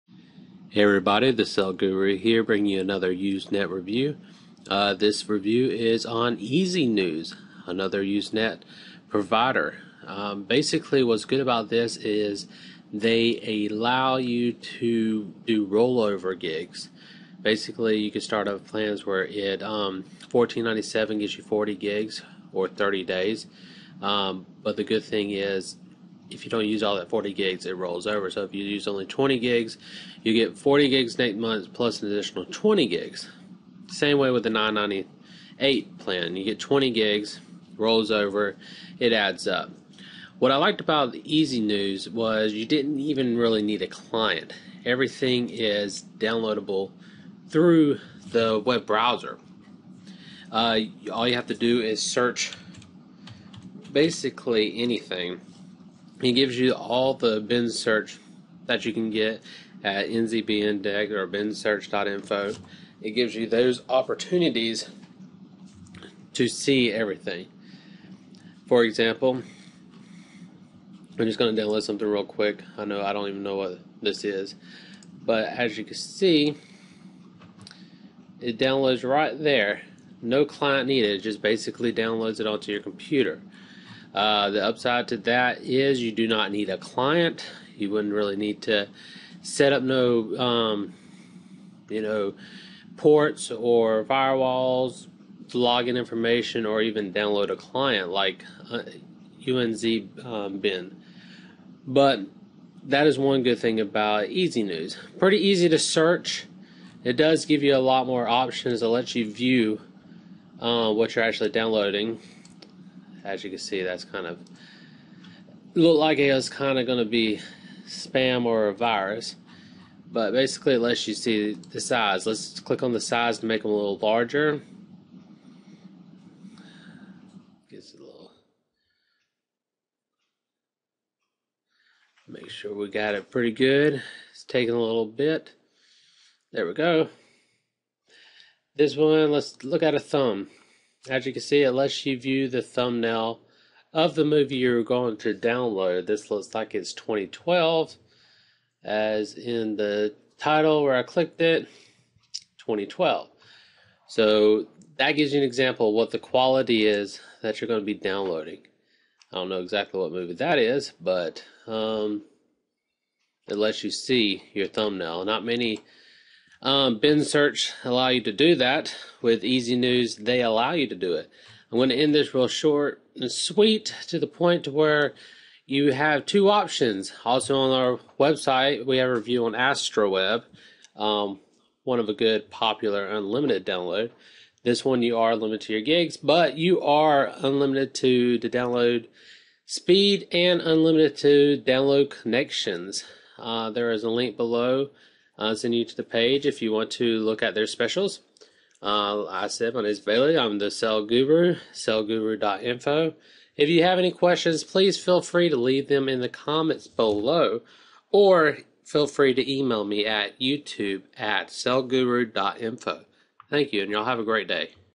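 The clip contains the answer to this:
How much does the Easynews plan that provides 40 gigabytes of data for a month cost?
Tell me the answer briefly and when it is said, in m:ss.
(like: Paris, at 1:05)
$14.97, at 0:20.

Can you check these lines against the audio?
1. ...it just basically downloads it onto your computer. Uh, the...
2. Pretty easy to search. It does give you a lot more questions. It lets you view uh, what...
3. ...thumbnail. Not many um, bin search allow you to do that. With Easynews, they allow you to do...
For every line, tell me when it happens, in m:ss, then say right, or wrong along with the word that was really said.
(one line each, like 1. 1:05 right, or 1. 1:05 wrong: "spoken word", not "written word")
1. 1:21 right
2. 1:45 wrong: "options", not "questions"
3. 2:44 right.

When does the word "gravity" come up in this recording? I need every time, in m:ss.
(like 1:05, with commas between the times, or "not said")
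not said.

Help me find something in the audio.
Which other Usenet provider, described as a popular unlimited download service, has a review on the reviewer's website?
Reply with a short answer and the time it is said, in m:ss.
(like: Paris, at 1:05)
Astraweb, at 2:59.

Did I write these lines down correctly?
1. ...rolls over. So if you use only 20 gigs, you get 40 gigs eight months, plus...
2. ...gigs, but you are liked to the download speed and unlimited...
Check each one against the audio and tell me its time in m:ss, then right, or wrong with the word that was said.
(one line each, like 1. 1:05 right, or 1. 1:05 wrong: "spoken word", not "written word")
1. 0:27 right
2. 3:05 wrong: "unlimited", not "liked".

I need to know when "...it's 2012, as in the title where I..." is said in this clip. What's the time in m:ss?
2:26.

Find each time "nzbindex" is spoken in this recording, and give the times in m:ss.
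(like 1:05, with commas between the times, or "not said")
1:00.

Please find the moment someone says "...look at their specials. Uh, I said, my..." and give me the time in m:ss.
3:17.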